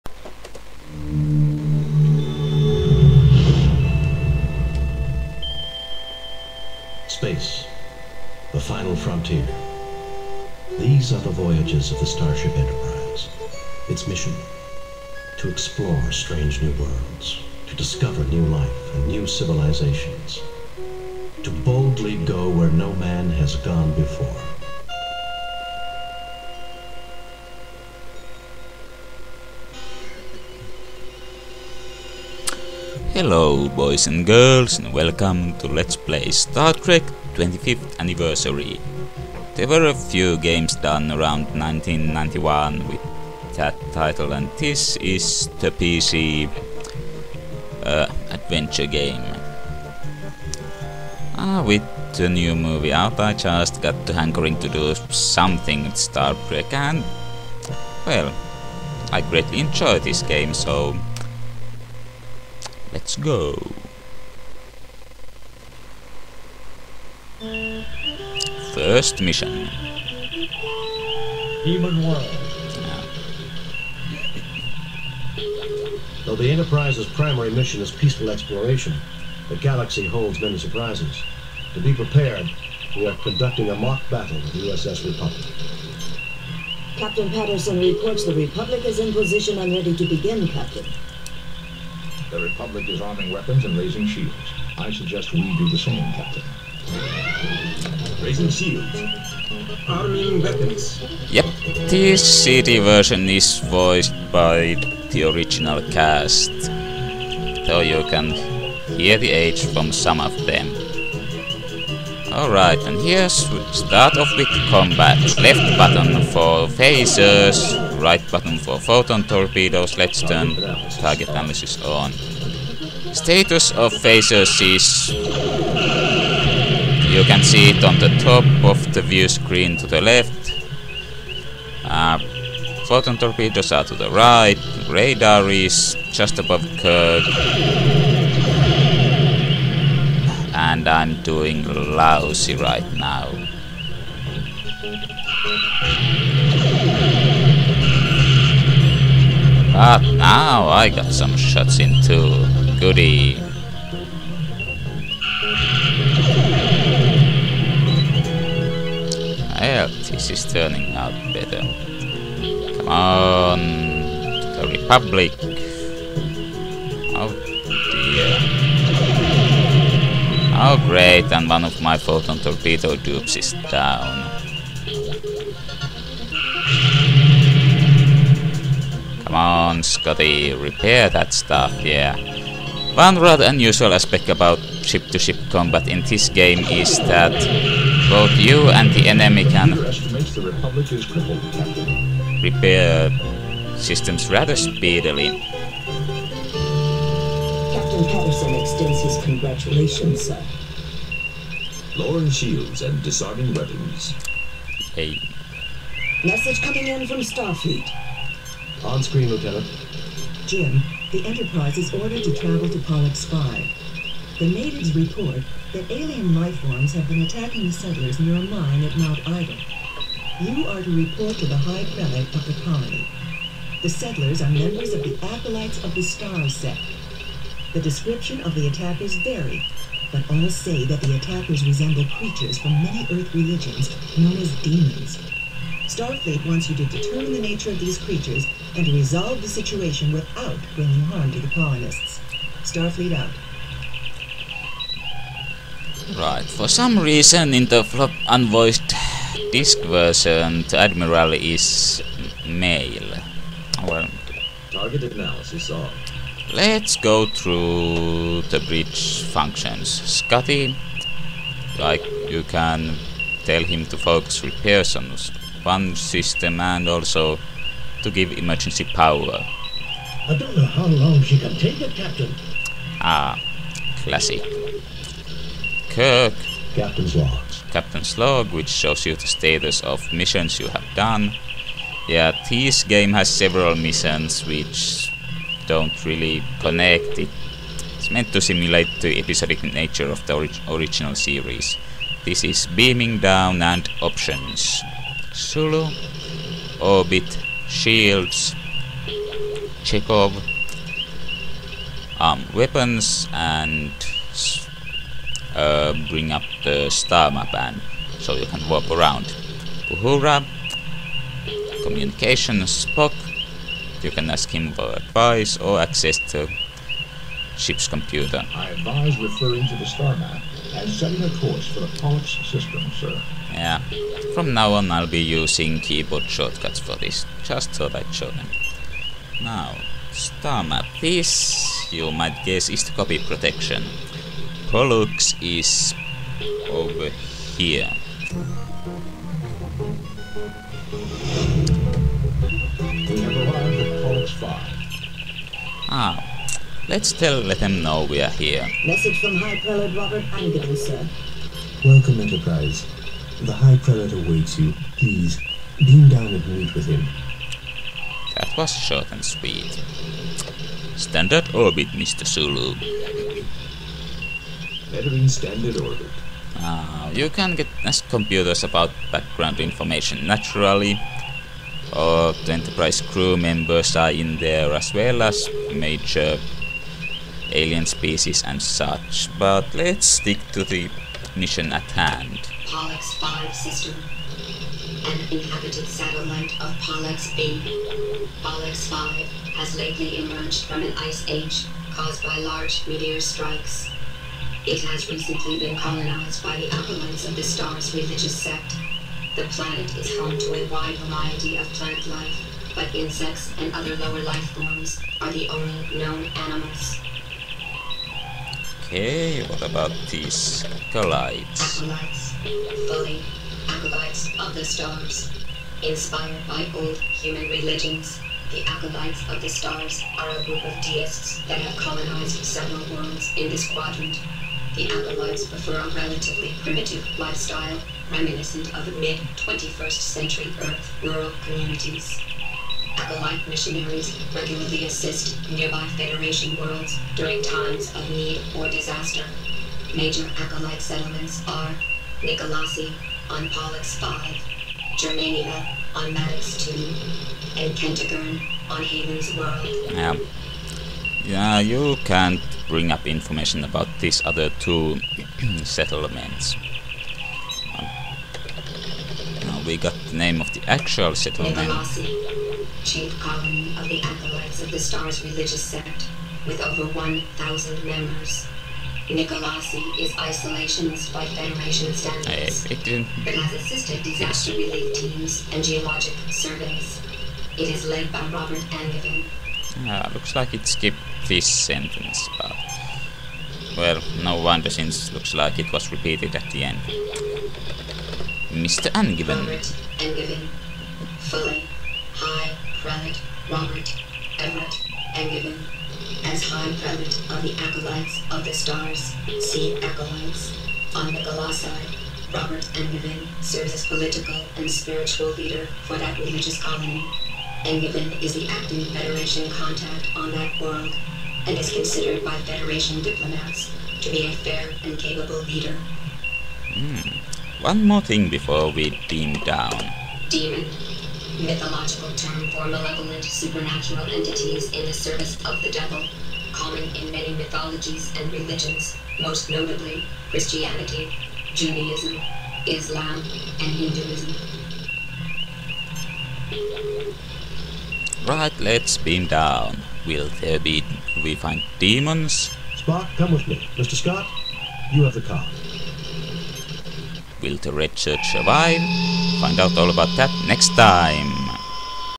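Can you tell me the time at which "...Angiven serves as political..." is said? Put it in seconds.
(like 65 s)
502 s.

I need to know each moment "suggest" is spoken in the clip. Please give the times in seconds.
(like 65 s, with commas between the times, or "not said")
94 s.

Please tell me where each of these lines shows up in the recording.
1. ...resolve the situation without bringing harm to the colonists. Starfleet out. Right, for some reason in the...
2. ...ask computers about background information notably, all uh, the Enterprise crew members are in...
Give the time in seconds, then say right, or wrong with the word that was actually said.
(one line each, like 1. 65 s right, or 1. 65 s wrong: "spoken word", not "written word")
1. 238 s right
2. 367 s wrong: "naturally", not "notably".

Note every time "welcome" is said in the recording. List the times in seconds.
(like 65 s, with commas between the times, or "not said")
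34 s, 351 s.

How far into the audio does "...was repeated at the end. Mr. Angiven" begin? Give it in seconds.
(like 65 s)
485 s.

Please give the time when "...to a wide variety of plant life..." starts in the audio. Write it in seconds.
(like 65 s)
400 s.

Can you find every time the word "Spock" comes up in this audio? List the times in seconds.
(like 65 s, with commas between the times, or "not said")
312 s, 542 s.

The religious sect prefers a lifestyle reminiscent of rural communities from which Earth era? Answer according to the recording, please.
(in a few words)
Mid-21st century.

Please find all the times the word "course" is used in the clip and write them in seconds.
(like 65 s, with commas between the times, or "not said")
321 s.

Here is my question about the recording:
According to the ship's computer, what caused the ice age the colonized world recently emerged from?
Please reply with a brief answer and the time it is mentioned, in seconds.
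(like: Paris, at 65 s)
Large meteor strikes, at 392 s.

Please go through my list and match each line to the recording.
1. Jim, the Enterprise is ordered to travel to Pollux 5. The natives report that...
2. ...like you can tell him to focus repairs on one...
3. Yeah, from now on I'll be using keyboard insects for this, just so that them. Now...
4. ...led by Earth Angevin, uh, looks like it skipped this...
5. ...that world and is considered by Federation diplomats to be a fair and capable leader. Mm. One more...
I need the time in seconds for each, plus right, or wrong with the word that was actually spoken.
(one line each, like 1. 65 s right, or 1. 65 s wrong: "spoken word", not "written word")
1. 210 s right
2. 261 s right
3. 323 s wrong: "shortcuts", not "insects"
4. 477 s wrong: "Robert", not "Earth"
5. 510 s right.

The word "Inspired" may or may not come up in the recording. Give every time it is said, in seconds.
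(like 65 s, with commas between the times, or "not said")
415 s.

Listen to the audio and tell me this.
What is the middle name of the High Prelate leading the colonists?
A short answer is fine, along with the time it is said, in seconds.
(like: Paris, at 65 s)
Everett, at 494 s.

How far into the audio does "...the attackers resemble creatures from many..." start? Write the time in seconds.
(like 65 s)
231 s.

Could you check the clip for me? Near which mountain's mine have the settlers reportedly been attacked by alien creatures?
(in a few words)
Mount Ida.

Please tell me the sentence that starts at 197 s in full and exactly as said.
Captain Patterson extends his congratulations, sir.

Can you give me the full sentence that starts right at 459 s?
now we got the name of the actual settlement.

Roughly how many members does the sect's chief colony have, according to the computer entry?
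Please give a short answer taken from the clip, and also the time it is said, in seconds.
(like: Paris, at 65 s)
Over 1,000, at 466 s.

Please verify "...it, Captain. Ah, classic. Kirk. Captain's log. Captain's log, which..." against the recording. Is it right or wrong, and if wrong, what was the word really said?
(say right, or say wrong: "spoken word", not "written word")
right.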